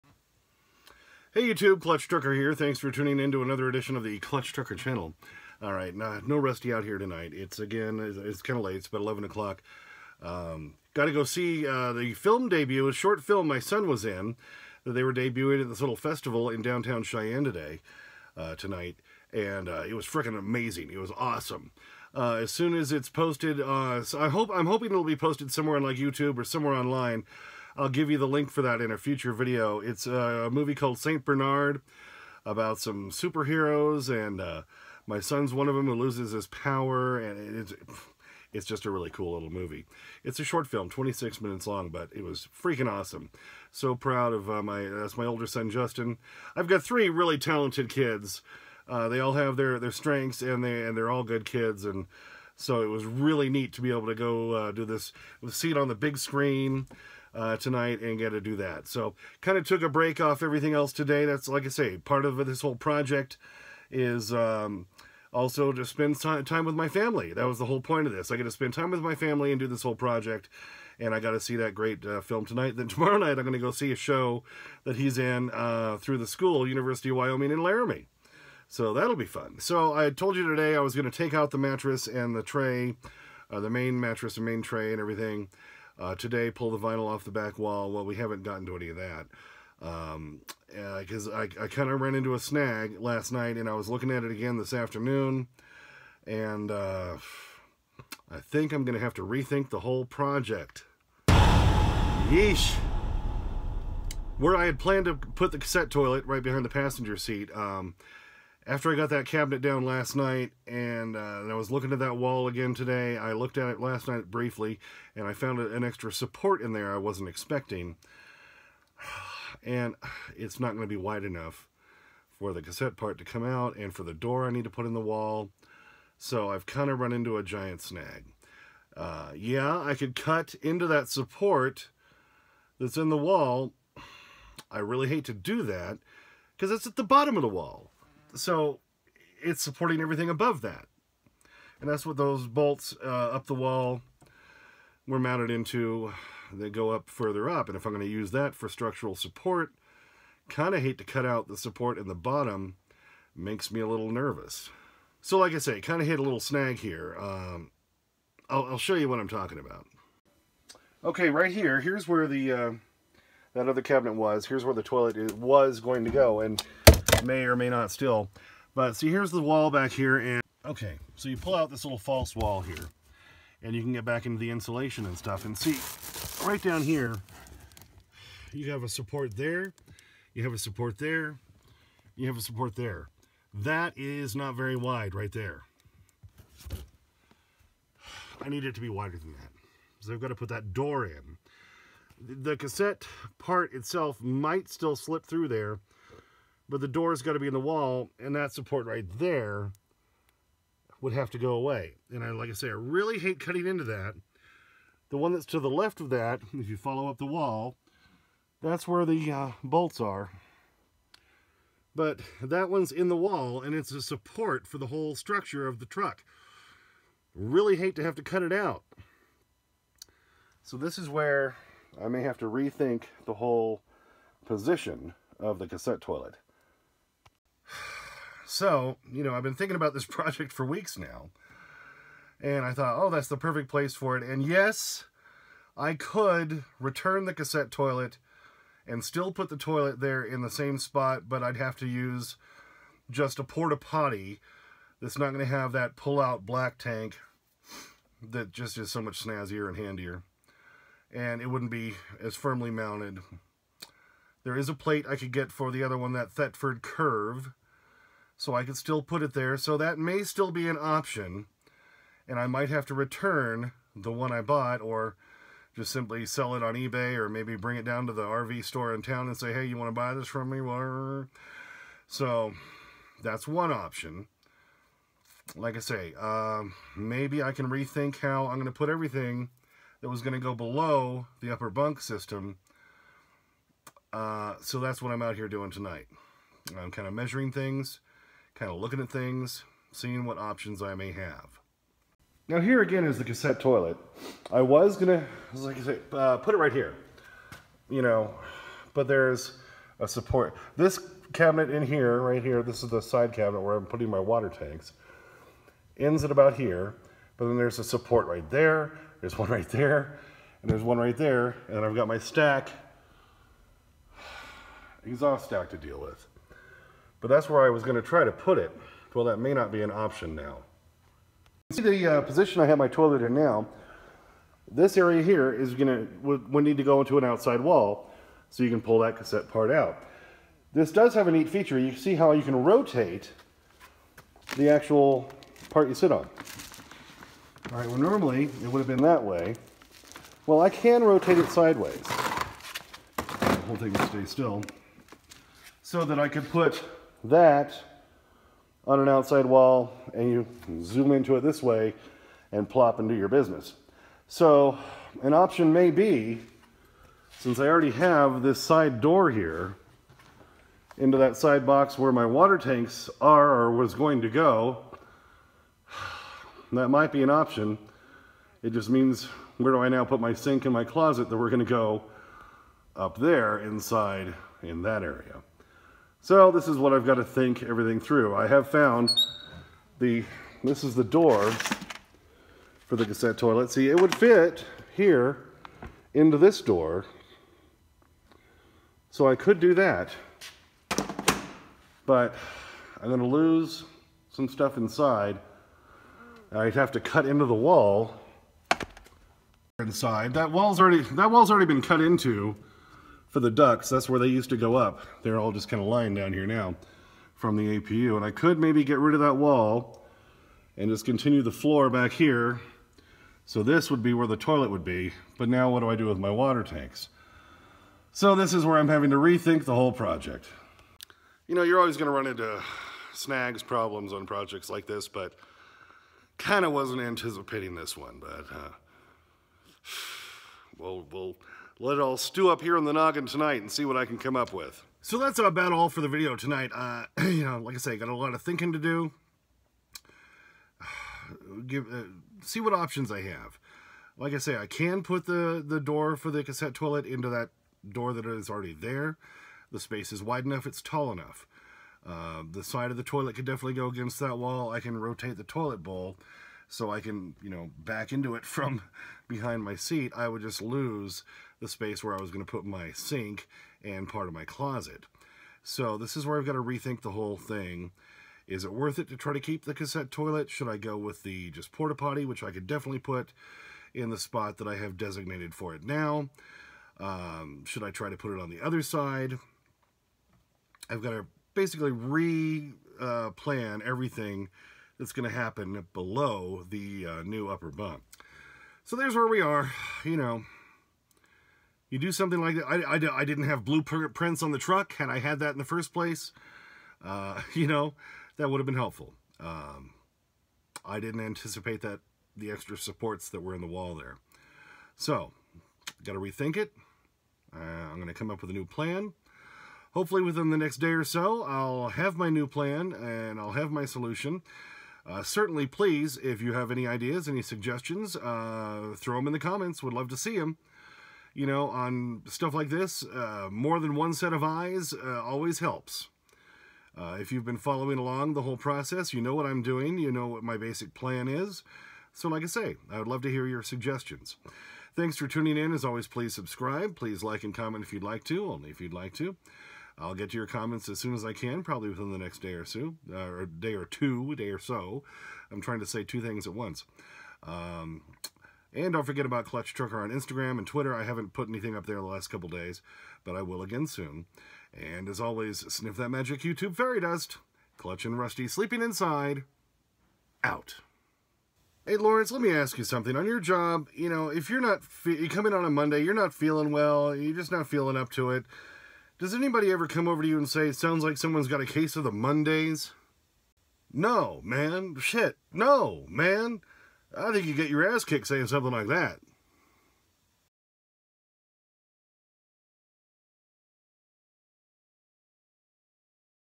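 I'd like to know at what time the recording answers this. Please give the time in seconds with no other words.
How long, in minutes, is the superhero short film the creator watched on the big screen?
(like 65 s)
40 s.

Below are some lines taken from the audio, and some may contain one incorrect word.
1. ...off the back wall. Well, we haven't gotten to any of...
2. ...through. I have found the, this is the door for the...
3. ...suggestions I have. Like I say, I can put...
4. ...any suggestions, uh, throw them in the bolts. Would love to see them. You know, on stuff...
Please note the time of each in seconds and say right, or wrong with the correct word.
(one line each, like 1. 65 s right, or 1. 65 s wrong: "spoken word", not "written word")
1. 87 s right
2. 377 s right
3. 442 s wrong: "options", not "suggestions"
4. 517 s wrong: "comments", not "bolts".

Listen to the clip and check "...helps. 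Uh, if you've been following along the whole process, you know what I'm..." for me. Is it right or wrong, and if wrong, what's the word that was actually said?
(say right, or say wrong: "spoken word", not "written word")
right.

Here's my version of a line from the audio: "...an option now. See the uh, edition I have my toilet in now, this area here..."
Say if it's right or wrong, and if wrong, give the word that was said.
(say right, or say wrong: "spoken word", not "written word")
wrong: "position", not "edition".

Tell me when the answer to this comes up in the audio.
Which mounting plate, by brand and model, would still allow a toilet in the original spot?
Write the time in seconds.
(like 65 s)
256 s.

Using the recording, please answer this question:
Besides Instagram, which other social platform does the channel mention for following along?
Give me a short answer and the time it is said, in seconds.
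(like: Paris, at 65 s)
Twitter, at 550 s.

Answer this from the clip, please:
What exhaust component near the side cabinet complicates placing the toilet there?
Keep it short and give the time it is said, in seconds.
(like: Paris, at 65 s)
Exhaust stack, at 315 s.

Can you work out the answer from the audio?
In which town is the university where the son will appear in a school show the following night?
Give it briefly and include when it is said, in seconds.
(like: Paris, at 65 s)
Laramie, at 77 s.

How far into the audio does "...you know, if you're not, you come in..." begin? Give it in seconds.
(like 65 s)
563 s.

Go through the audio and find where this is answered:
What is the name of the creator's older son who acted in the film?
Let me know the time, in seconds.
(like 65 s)
45 s.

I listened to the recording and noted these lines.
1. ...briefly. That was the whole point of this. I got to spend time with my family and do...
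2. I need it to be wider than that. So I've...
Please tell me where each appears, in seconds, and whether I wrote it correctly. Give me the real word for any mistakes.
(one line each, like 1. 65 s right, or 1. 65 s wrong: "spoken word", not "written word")
1. 66 s wrong: "family", not "briefly"
2. 188 s right.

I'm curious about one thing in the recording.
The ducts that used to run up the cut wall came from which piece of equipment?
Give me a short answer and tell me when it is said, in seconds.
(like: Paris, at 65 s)
APU, at 407 s.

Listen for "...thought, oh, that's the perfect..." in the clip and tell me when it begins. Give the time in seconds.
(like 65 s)
232 s.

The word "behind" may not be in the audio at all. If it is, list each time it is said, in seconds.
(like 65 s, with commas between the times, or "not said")
106 s, 459 s.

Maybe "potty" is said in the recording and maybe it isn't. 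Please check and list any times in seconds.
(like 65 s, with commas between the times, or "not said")
243 s, 471 s.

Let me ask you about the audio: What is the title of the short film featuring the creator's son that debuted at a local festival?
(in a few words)
St. Bernard.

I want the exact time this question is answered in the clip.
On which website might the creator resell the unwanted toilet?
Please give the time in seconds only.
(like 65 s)
266 s.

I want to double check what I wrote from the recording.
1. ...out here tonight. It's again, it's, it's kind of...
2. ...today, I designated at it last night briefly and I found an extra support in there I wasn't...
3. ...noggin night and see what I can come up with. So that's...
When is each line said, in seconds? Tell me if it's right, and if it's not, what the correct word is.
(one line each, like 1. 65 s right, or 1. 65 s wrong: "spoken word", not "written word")
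1. 6 s right
2. 112 s wrong: "looked", not "designated"
3. 432 s wrong: "tonight", not "night".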